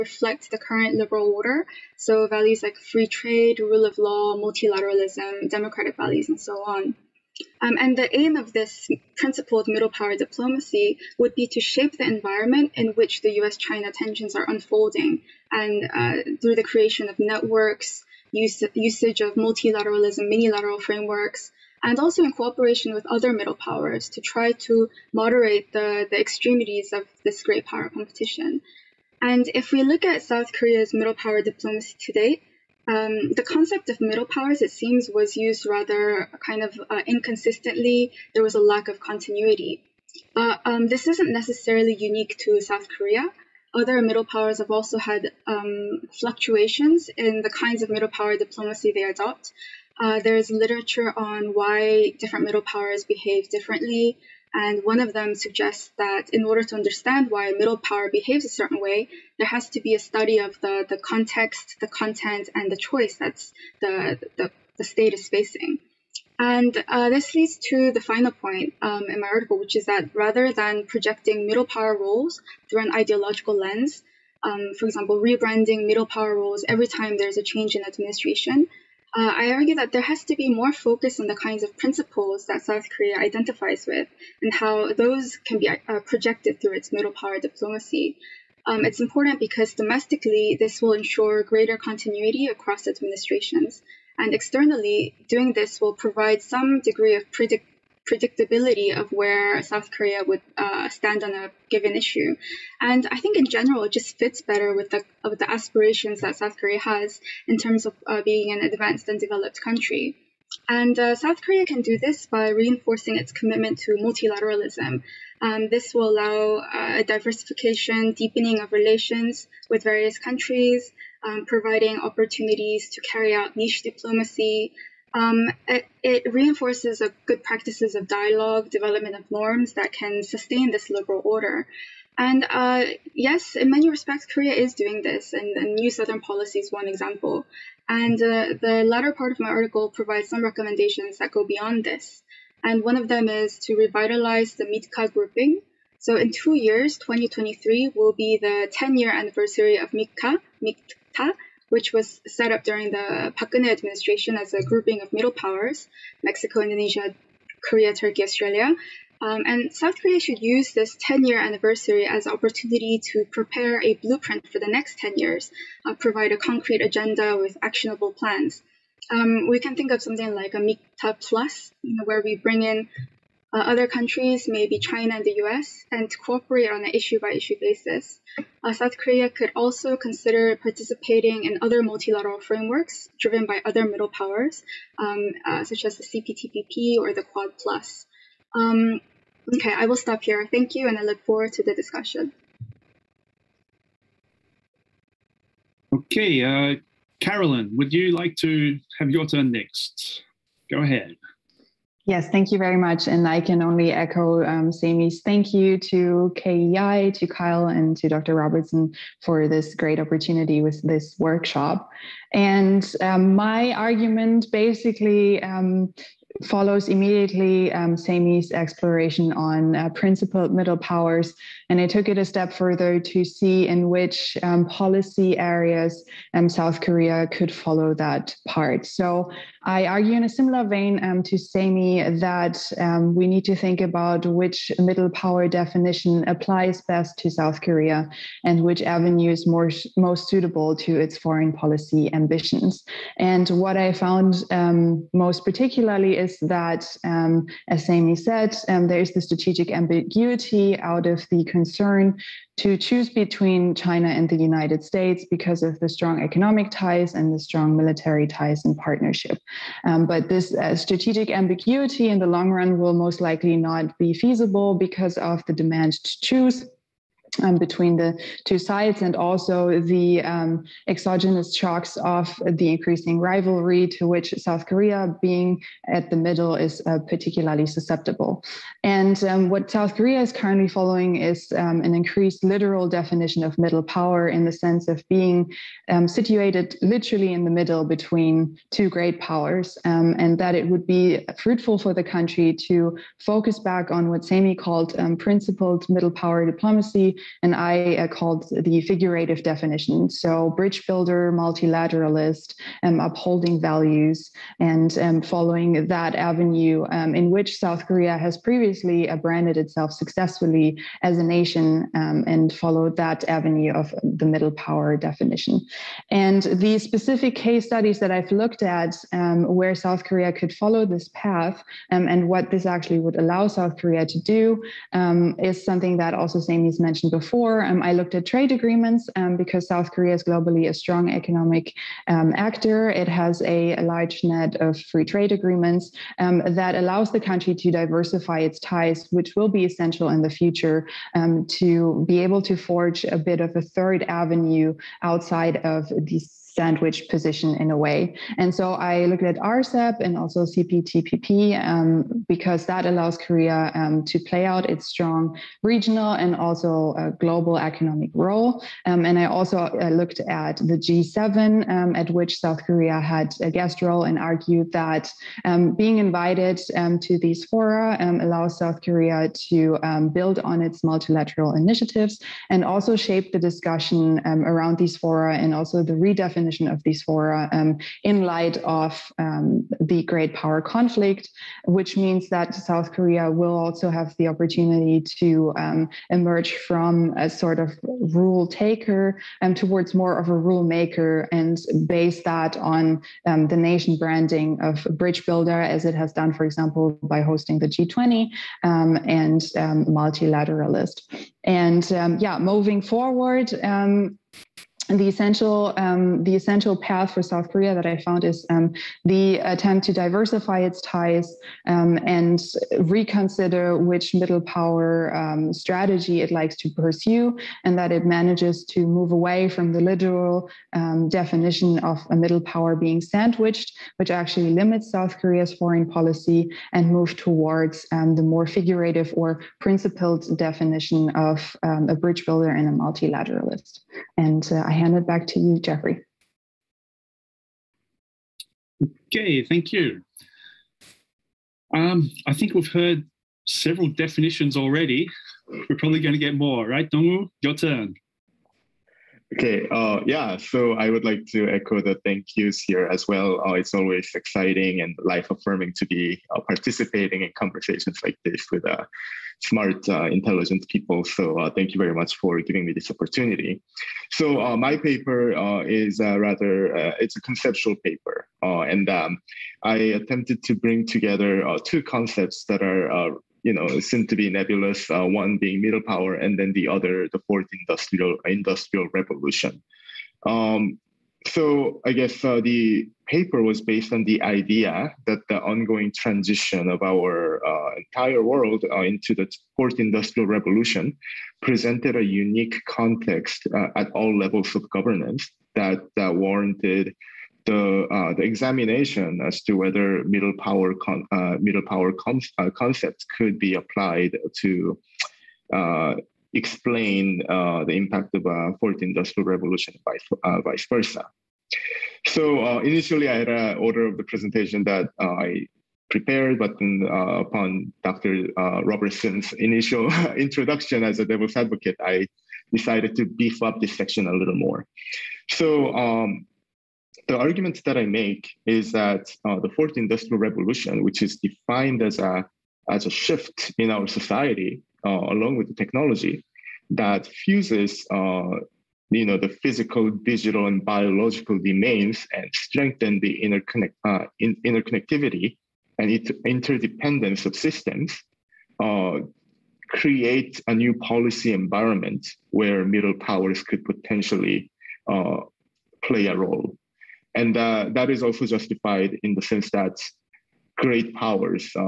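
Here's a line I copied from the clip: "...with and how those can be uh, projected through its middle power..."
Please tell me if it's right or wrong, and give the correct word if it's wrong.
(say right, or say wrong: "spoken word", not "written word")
right.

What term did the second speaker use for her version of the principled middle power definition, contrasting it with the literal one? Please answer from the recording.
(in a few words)
figurative definition.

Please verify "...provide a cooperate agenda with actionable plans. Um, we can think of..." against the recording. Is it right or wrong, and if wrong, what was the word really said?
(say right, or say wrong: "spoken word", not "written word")
wrong: "concrete", not "cooperate".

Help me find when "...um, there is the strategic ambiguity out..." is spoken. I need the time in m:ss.
4:08.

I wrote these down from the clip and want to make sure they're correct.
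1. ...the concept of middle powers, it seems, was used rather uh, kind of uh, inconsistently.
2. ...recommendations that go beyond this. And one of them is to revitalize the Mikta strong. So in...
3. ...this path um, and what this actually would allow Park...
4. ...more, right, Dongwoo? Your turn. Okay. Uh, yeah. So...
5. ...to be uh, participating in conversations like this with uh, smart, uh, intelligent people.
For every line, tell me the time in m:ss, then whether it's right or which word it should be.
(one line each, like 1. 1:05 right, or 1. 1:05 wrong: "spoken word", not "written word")
1. 0:33 right
2. 2:20 wrong: "grouping", not "strong"
3. 5:20 wrong: "South", not "Park"
4. 7:26 right
5. 7:35 right.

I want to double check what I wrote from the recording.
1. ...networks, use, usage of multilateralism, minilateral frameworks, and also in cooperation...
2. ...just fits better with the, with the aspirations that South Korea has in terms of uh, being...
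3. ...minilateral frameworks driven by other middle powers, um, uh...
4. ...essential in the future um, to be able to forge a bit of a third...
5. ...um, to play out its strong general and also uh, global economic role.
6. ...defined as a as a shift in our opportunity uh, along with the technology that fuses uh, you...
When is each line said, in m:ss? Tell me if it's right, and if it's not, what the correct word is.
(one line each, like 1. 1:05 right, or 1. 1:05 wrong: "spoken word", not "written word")
1. 0:17 right
2. 1:43 right
3. 3:01 wrong: "multilateral", not "minilateral"
4. 5:39 right
5. 5:53 wrong: "regional", not "general"
6. 8:51 wrong: "society", not "opportunity".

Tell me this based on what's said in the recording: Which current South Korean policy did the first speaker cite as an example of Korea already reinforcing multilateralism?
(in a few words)
New Southern Policy.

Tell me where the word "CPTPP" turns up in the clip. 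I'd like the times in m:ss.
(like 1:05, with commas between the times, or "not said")
3:06, 5:50.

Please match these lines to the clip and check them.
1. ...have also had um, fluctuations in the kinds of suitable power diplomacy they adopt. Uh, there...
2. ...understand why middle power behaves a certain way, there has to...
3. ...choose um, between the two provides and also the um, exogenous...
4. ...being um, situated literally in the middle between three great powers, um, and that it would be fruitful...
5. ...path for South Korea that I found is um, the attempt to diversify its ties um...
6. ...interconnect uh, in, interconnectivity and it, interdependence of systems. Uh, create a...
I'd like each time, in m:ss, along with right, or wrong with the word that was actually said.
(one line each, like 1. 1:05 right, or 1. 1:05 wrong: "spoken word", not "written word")
1. 0:44 wrong: "middle", not "suitable"
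2. 0:56 right
3. 4:26 wrong: "sides", not "provides"
4. 4:45 wrong: "two", not "three"
5. 6:46 right
6. 9:03 right.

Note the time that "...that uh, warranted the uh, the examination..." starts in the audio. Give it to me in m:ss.
8:15.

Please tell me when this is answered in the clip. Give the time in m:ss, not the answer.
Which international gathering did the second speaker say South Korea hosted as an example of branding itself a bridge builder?
6:37.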